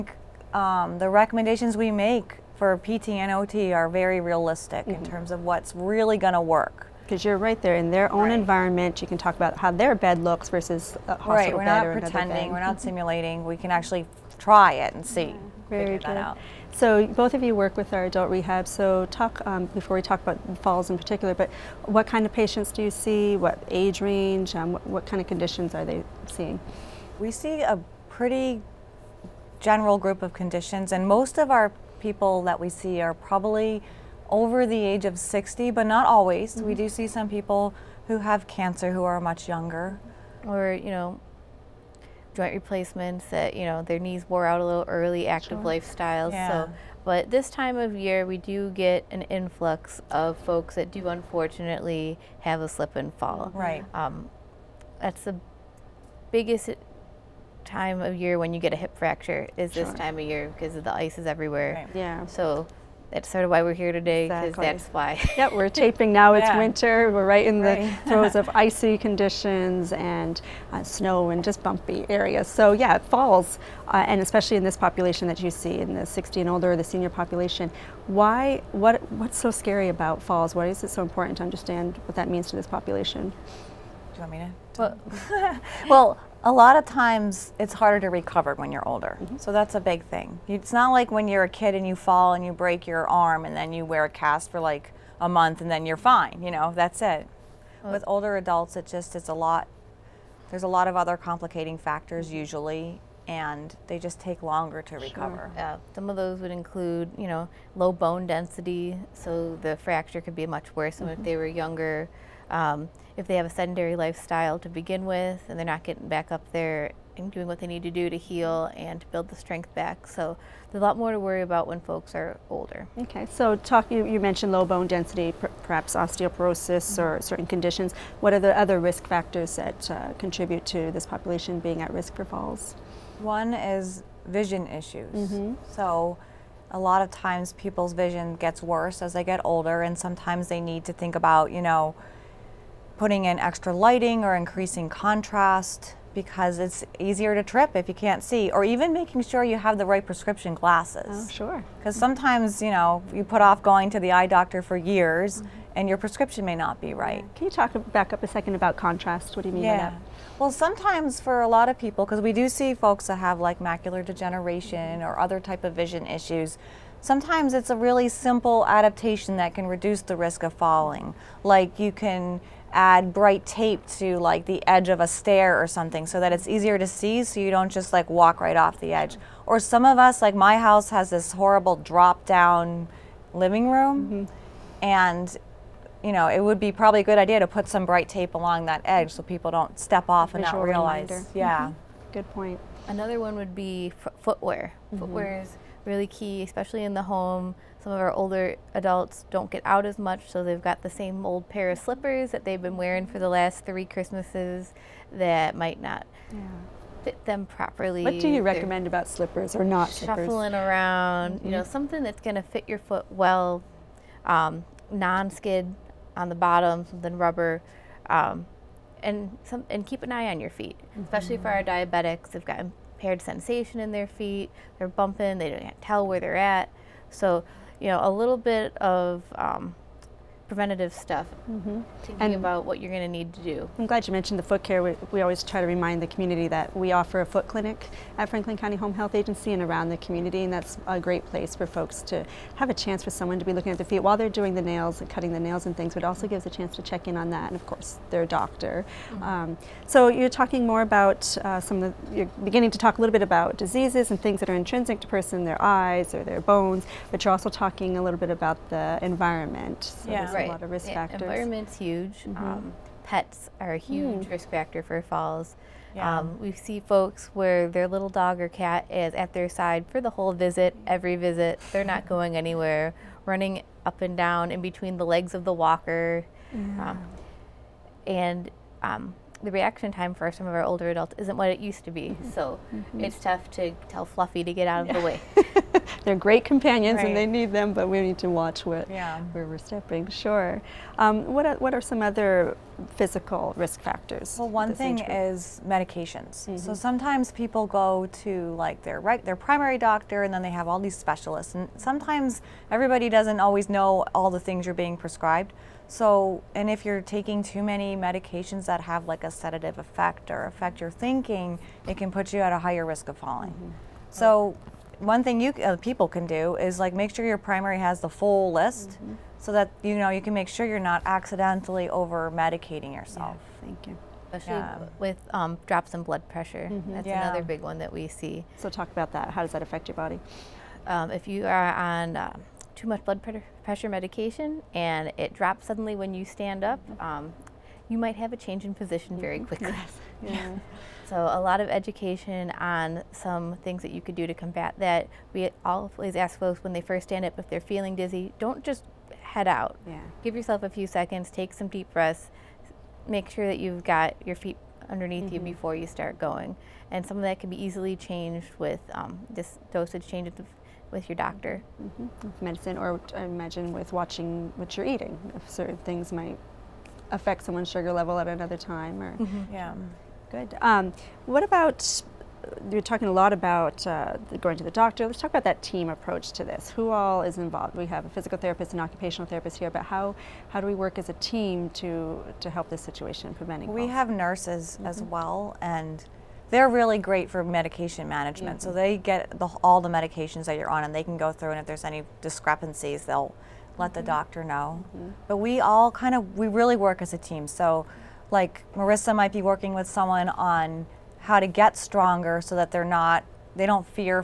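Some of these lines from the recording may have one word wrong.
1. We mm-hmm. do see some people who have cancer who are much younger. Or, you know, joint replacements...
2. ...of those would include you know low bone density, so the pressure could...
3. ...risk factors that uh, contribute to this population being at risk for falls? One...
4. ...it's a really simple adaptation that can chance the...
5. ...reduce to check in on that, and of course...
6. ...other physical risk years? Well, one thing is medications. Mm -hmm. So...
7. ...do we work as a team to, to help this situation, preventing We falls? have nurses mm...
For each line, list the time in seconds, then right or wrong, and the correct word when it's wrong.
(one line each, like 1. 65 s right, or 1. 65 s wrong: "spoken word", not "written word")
1. 36 s right
2. 106 s wrong: "fracture", not "pressure"
3. 128 s right
4. 167 s wrong: "reduce", not "chance"
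5. 246 s wrong: "chance", not "reduce"
6. 292 s wrong: "factors", not "years"
7. 380 s right.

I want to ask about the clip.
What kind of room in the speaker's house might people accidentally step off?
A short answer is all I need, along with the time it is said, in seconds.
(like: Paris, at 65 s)
drop down living room, at 181 s.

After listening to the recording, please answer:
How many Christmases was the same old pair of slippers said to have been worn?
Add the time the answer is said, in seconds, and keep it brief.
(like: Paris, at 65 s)
3, at 203 s.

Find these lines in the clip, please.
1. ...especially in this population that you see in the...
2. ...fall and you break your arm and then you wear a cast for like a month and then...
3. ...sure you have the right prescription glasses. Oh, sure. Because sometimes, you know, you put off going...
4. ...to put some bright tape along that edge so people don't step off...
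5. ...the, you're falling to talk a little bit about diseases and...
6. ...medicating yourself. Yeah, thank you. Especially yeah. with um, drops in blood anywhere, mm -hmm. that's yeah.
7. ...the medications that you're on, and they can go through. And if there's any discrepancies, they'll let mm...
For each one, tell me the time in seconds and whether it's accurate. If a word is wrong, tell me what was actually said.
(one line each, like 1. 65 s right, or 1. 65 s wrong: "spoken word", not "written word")
1. 74 s right
2. 91 s right
3. 149 s right
4. 187 s right
5. 251 s wrong: "beginning", not "falling"
6. 322 s wrong: "pressure", not "anywhere"
7. 389 s right.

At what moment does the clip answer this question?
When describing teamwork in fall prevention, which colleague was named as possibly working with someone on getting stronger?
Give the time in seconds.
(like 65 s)
398 s.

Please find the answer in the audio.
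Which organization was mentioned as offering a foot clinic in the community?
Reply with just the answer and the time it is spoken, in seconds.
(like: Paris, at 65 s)
Franklin County Home Health Agency, at 238 s.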